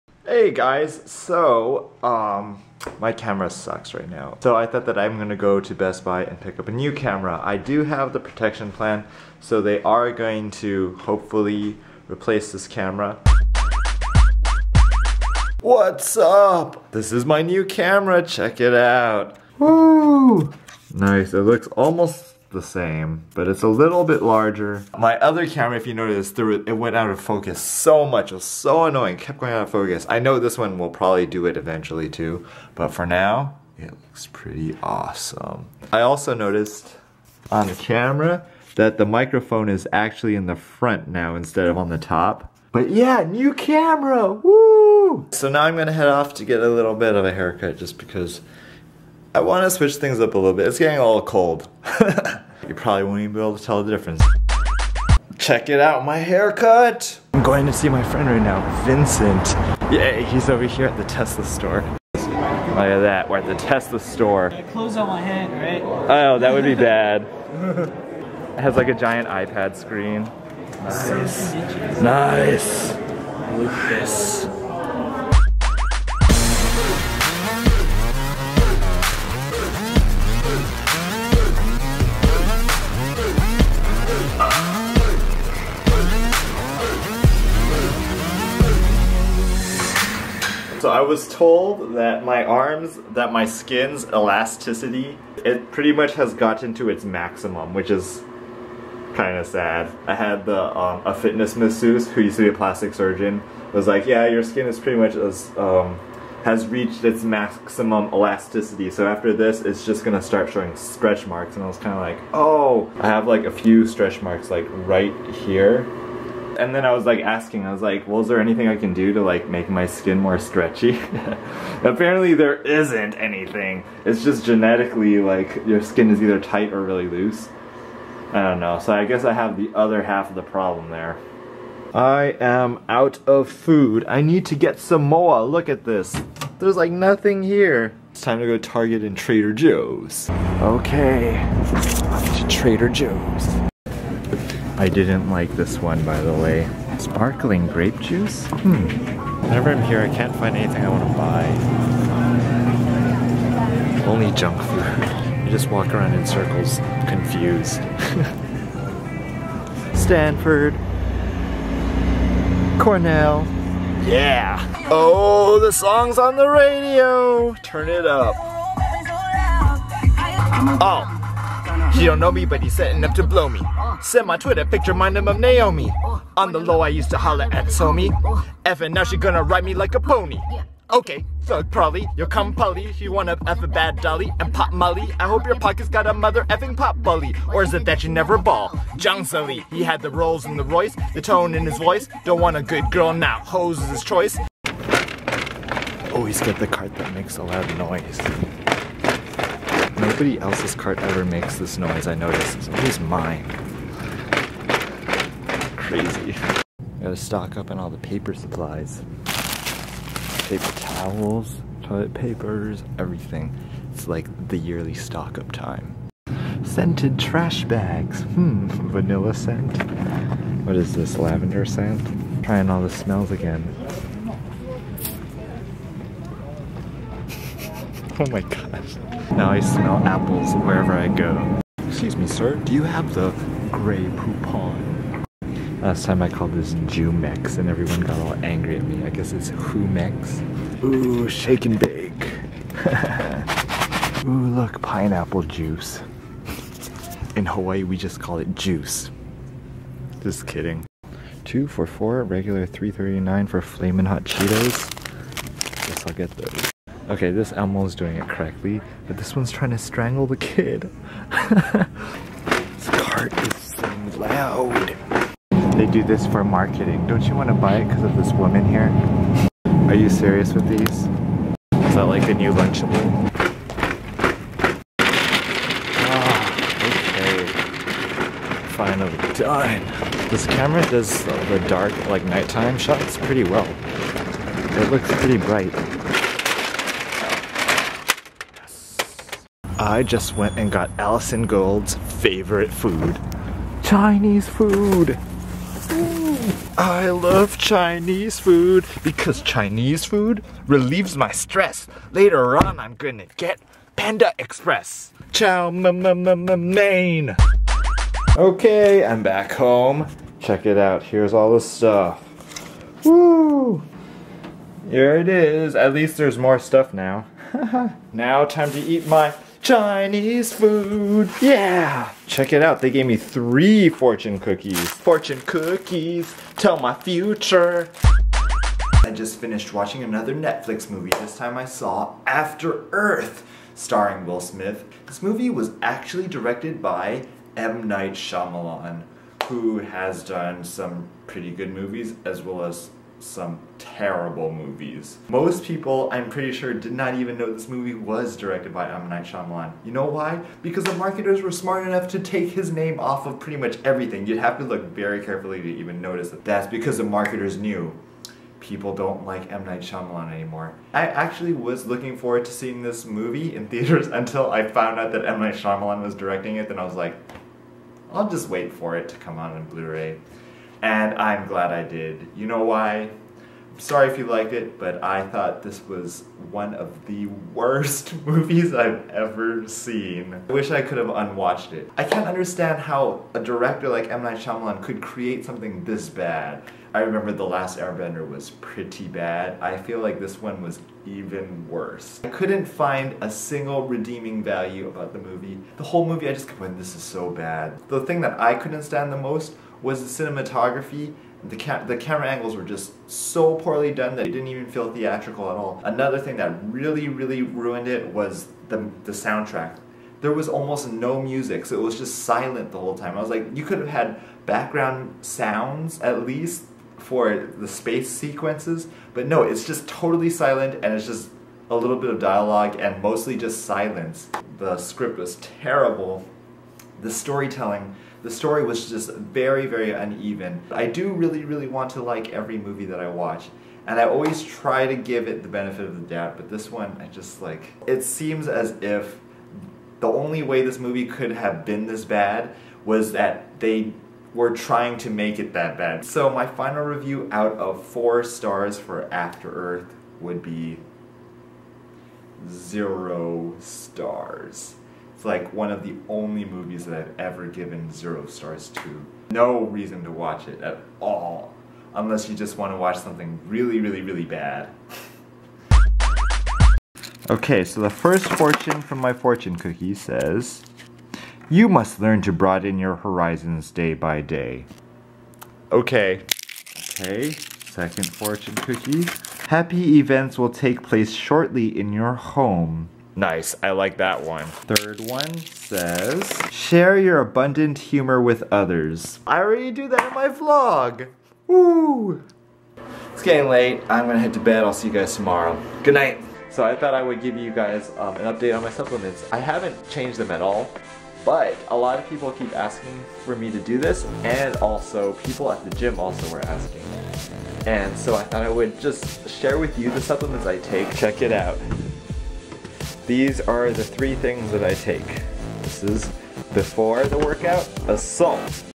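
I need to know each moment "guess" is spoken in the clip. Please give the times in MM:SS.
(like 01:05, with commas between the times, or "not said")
02:09, 03:59, 04:15.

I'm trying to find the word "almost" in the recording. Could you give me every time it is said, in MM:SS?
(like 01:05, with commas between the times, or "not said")
00:21, 06:50.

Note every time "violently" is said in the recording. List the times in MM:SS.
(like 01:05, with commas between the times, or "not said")
not said.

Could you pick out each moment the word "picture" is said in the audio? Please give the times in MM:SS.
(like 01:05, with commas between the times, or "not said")
02:54.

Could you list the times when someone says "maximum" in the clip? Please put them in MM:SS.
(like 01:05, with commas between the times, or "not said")
01:37, 01:47.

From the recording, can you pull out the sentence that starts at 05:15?
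At least there's more stuff now.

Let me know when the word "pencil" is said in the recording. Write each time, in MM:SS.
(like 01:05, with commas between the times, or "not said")
not said.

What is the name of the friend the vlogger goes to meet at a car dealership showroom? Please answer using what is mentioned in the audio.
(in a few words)
Vincent.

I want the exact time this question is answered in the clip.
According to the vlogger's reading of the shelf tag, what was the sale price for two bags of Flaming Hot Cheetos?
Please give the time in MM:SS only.
04:11.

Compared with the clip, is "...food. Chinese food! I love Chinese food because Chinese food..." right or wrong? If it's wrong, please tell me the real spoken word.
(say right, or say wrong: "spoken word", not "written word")
right.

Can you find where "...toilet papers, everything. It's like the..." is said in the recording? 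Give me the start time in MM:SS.
03:31.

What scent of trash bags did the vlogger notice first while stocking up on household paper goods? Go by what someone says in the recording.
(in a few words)
vanilla.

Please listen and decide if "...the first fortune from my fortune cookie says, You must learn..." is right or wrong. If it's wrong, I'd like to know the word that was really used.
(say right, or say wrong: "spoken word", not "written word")
right.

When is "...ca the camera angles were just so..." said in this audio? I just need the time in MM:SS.
06:41.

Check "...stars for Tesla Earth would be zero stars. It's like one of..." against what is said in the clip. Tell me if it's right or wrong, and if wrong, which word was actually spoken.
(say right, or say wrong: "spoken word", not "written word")
wrong: "After", not "Tesla".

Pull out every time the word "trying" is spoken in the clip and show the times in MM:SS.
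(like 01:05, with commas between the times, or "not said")
03:42, 04:19, 07:24.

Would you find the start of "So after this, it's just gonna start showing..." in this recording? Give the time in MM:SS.
01:48.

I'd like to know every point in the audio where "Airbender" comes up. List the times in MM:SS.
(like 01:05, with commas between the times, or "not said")
06:27.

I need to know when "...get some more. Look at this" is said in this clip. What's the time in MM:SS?
02:14.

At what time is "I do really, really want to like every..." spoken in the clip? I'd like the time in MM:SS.
07:10.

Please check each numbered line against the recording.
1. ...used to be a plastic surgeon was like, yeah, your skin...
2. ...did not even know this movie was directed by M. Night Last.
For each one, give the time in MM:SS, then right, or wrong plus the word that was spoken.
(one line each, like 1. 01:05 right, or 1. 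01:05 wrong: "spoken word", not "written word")
1. 01:42 right
2. 05:46 wrong: "Shyamalan", not "Last".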